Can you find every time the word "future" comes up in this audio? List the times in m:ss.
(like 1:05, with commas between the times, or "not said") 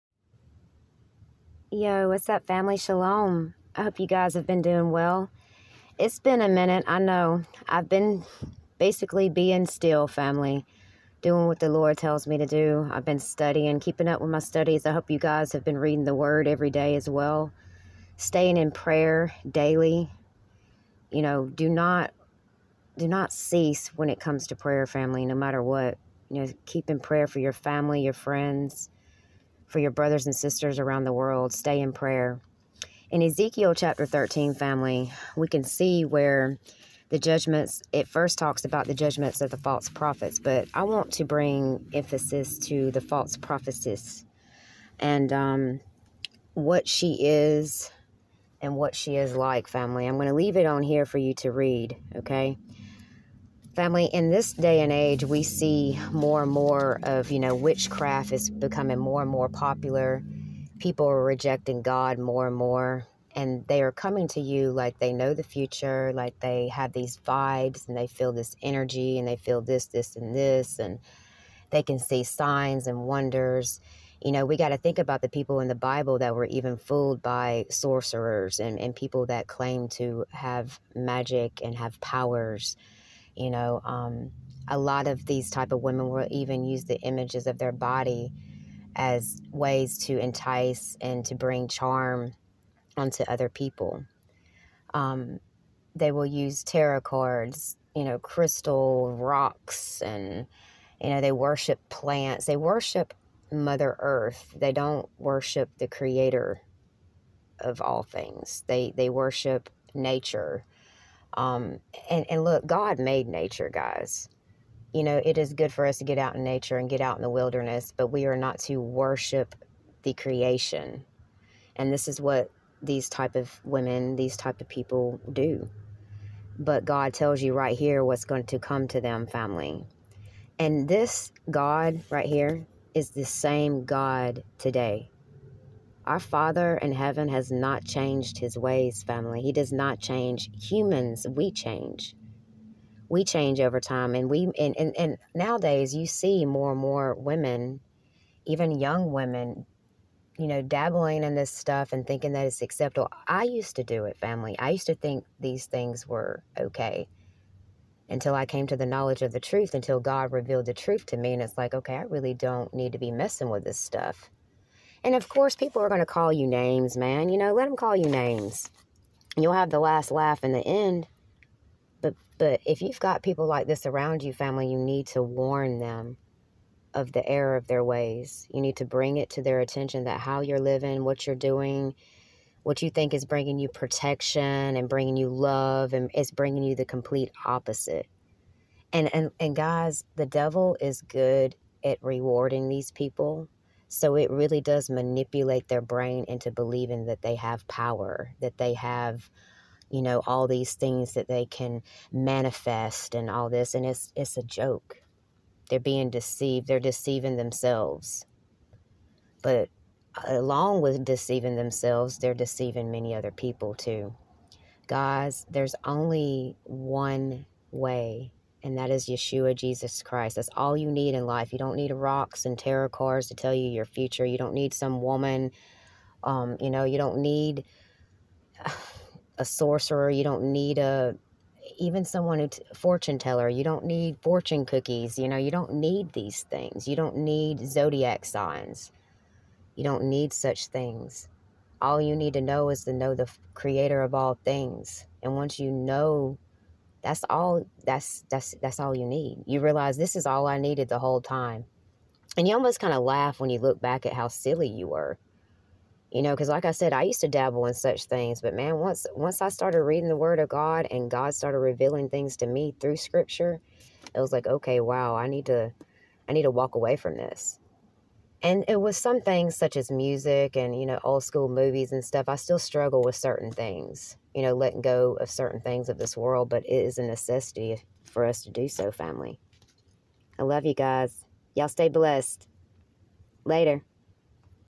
1:05, 3:43.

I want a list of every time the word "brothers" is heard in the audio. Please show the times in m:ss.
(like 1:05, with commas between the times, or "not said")
0:29.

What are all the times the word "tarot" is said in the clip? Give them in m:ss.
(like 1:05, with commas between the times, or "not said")
1:36, 3:42.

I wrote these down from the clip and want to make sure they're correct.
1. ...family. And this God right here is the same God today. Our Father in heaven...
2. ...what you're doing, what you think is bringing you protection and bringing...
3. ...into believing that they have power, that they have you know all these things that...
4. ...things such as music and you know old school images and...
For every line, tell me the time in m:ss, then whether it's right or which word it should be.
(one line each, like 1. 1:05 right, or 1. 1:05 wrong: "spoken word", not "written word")
1. 2:09 right
2. 3:01 right
3. 3:16 right
4. 4:29 wrong: "movies", not "images".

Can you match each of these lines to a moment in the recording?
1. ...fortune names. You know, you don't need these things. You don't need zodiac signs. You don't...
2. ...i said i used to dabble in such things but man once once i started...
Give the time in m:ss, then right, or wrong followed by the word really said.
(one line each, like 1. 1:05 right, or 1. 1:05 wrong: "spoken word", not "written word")
1. 3:54 wrong: "cookies", not "names"
2. 4:16 right.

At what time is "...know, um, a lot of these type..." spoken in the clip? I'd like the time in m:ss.
1:23.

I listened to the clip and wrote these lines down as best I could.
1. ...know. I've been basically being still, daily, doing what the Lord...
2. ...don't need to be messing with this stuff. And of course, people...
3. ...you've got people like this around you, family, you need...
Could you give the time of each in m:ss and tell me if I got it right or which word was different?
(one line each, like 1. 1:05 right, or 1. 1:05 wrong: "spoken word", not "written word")
1. 0:06 wrong: "family", not "daily"
2. 2:42 right
3. 2:52 right.